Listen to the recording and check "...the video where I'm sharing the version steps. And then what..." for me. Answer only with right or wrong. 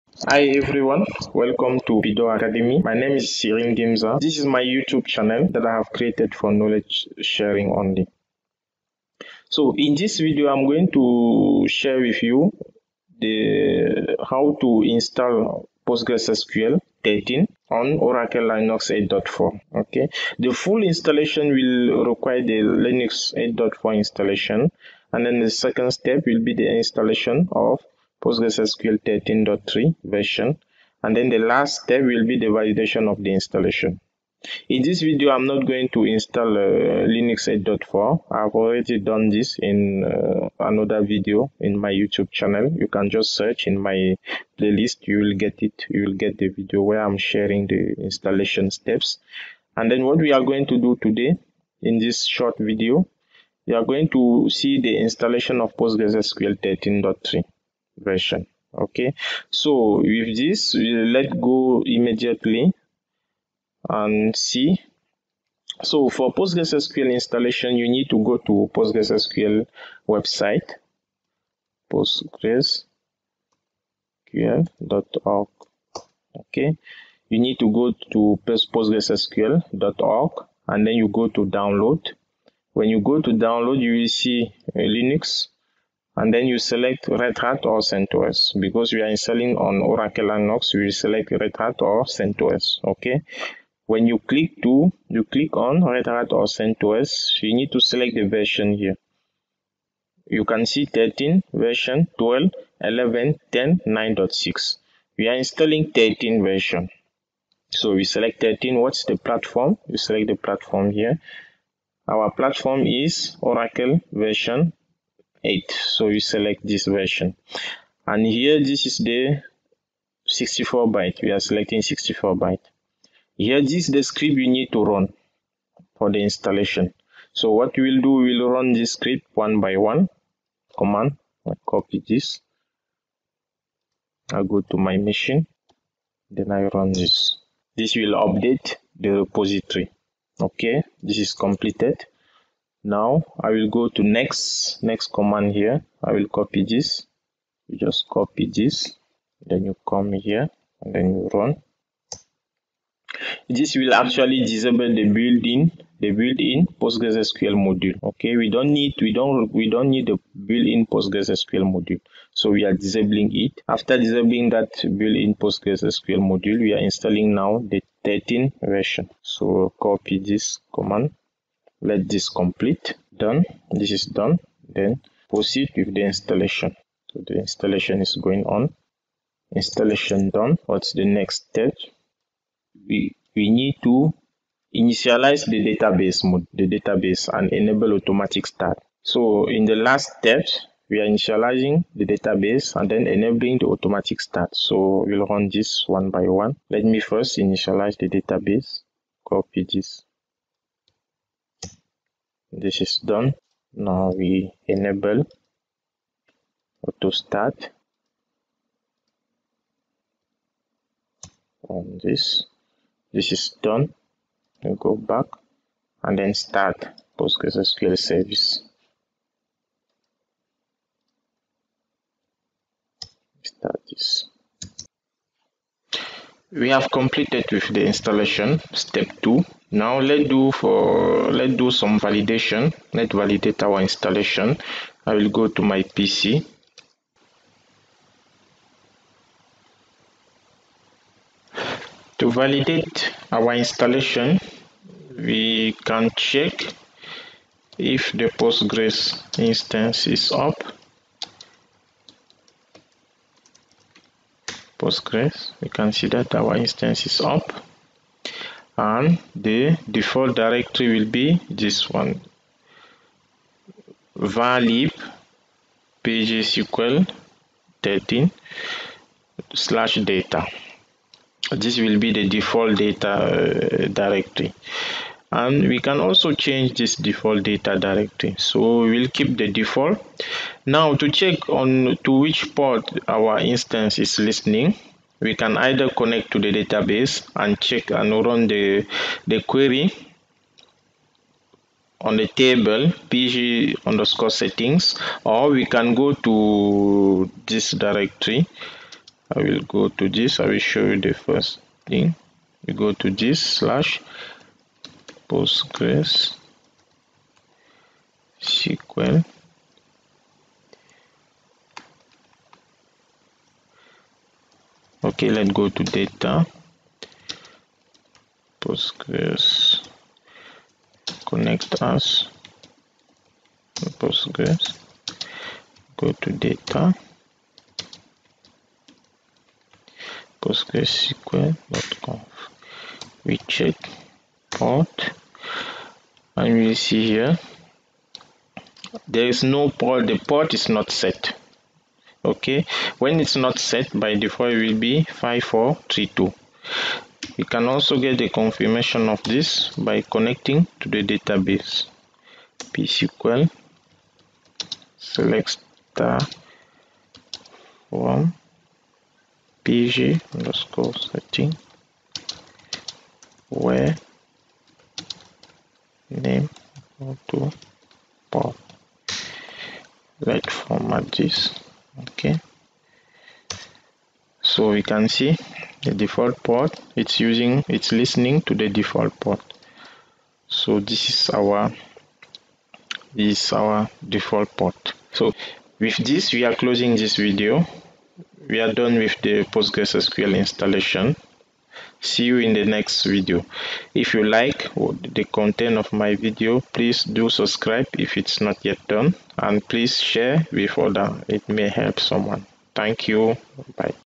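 wrong.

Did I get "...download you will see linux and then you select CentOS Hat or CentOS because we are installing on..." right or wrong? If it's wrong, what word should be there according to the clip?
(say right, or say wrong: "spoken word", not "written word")
wrong: "Red", not "CentOS".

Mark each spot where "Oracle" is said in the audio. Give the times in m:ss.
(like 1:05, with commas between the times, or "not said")
0:17, 1:29, 1:53.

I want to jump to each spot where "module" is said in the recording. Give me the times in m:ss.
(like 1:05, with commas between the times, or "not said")
2:37, 2:41, 2:46.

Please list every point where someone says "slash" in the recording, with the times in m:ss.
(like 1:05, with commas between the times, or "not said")
4:29, 5:03.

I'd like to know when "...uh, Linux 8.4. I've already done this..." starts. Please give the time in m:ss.
0:36.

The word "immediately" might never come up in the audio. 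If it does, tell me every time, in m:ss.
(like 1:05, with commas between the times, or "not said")
1:01.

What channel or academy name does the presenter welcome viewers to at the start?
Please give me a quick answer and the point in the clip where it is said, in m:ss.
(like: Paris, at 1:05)
Pidoa Academy, at 0:02.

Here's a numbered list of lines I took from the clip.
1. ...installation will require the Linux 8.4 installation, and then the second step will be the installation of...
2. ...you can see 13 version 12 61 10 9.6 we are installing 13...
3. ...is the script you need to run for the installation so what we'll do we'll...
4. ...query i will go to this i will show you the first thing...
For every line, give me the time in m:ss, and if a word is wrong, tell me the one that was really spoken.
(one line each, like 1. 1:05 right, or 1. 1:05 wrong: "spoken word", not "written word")
1. 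0:20 right
2. 1:40 wrong: "11", not "61"
3. 2:03 right
4. 4:57 wrong: "directory", not "query".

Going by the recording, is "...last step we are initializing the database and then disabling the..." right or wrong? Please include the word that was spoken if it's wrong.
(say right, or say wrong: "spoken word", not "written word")
wrong: "enabling", not "disabling".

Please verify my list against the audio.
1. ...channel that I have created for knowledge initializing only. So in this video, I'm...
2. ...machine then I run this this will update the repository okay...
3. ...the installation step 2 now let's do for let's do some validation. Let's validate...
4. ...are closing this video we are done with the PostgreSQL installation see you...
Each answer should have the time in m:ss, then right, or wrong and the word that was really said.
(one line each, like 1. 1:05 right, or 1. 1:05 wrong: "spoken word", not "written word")
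1. 0:05 wrong: "sharing", not "initializing"
2. 2:14 right
3. 3:47 right
4. 6:26 right.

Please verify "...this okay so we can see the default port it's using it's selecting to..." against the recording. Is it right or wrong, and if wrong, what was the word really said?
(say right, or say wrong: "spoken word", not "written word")
wrong: "listening", not "selecting".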